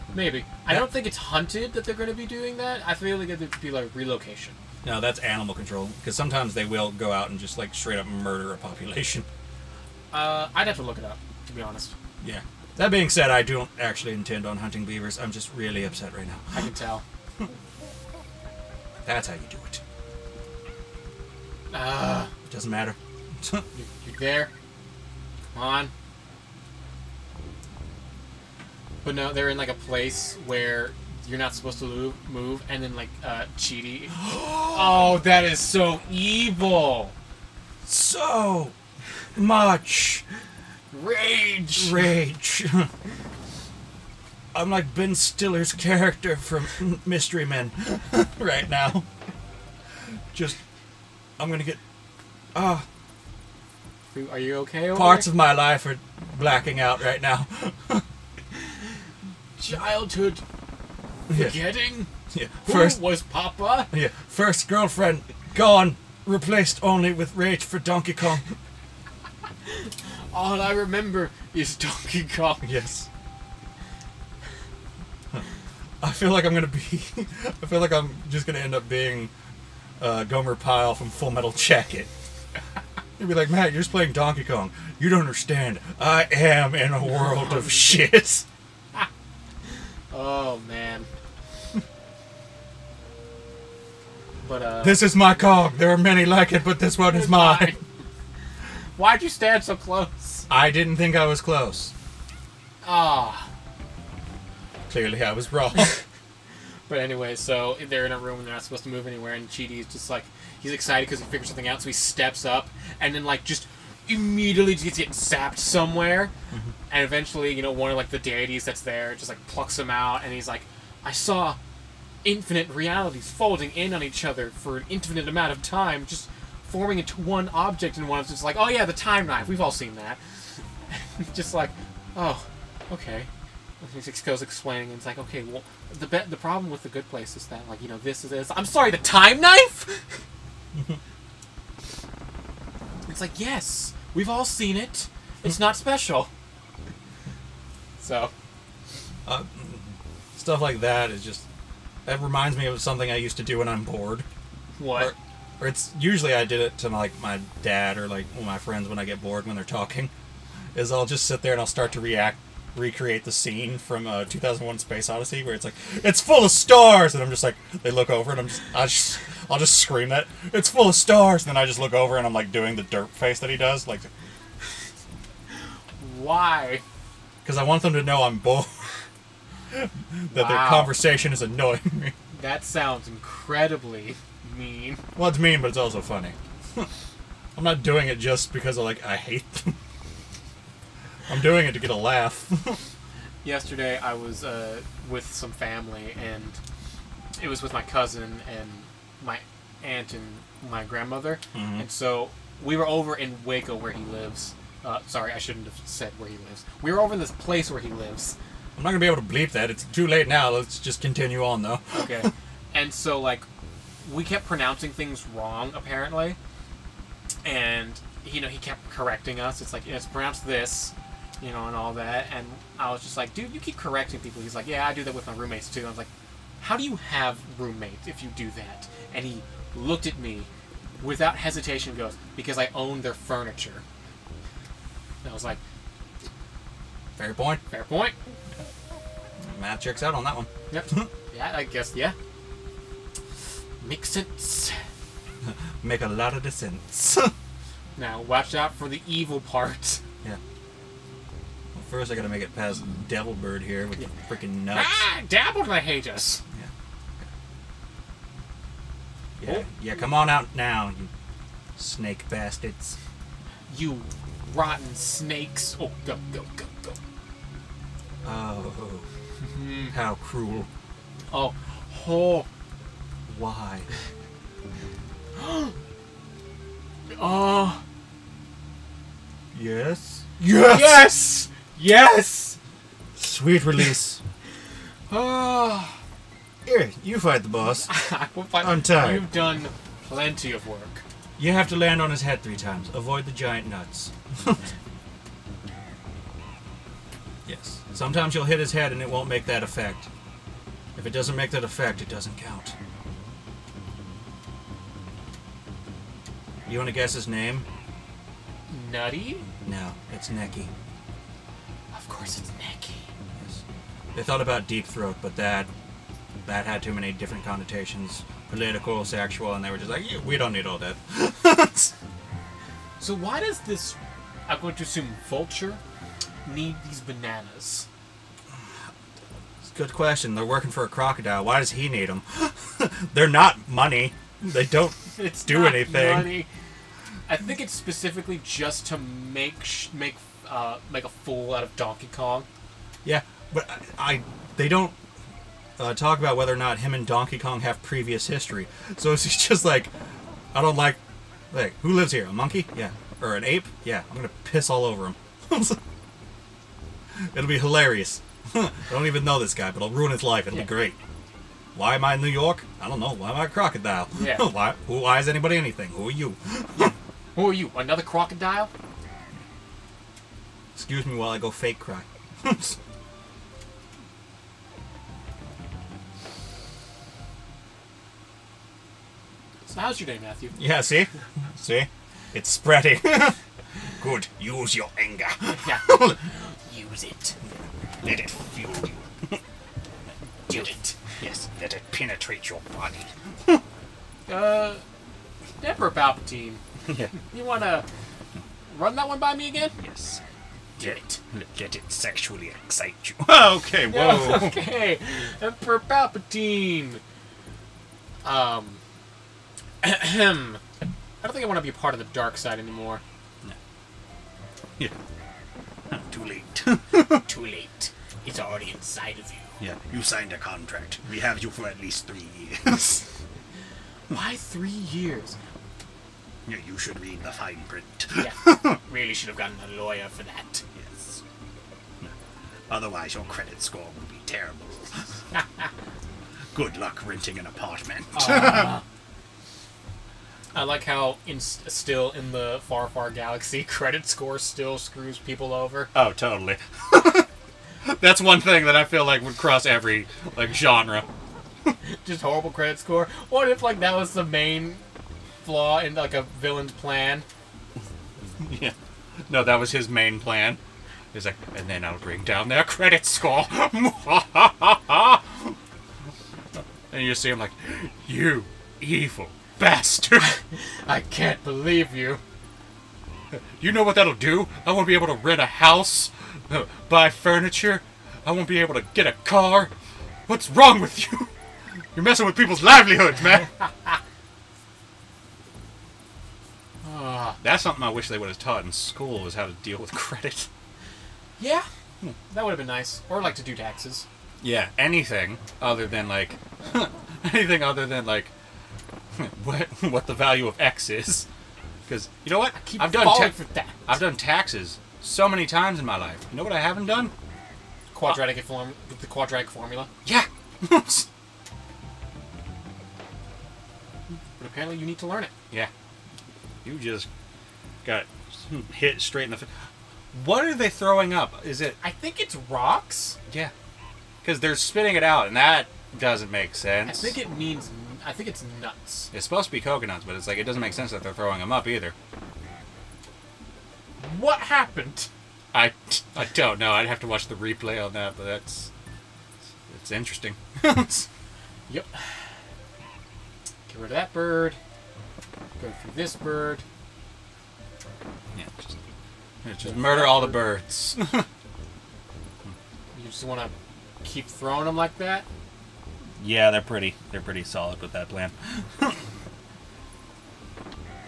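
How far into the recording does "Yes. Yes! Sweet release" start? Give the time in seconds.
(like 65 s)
280 s.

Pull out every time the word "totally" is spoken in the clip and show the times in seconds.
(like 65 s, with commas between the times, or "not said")
446 s.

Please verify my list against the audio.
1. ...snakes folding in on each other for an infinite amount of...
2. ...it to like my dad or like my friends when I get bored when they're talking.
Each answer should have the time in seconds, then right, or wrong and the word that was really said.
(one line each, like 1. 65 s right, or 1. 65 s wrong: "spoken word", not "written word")
1. 122 s wrong: "realities", not "snakes"
2. 156 s right.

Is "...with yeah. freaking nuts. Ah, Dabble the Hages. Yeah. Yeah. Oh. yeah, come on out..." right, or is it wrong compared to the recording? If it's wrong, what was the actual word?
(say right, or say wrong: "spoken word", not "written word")
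right.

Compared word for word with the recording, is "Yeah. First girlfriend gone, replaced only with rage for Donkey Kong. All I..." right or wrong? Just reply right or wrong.
right.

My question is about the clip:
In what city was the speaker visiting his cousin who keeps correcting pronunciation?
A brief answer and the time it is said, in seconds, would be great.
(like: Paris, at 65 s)
Waco, at 203 s.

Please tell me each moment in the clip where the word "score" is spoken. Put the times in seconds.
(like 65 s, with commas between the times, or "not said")
433 s, 444 s, 452 s, 463 s.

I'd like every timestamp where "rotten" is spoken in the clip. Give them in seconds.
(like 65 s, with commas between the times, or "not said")
264 s.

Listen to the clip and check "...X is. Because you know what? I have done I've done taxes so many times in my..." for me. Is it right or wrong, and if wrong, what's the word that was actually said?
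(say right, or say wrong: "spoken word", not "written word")
right.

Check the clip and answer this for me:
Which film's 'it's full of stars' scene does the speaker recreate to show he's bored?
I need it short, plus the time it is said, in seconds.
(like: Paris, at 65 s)
2001: Space Odyssey, at 164 s.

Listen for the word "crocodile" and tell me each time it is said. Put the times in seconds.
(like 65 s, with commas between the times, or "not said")
330 s, 363 s, 368 s.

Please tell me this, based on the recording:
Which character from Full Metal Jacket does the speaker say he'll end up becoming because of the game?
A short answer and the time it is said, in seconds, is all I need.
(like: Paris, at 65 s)
Gomer Pyle, at 80 s.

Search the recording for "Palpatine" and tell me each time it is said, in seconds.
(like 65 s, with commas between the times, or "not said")
395 s, 405 s.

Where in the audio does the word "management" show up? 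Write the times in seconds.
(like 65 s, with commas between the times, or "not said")
not said.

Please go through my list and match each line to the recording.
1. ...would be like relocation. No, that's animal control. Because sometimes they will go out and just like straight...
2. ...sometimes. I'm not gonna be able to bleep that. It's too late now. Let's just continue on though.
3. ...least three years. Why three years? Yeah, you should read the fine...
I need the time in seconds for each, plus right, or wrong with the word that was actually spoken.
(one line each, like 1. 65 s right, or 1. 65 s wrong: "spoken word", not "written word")
1. 3 s right
2. 207 s wrong: "lives", not "sometimes"
3. 421 s right.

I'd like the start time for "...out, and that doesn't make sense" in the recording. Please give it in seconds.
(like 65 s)
525 s.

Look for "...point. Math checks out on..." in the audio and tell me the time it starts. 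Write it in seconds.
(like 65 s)
237 s.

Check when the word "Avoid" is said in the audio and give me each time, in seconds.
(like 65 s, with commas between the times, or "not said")
292 s.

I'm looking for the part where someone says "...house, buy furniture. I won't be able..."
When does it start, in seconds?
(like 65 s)
475 s.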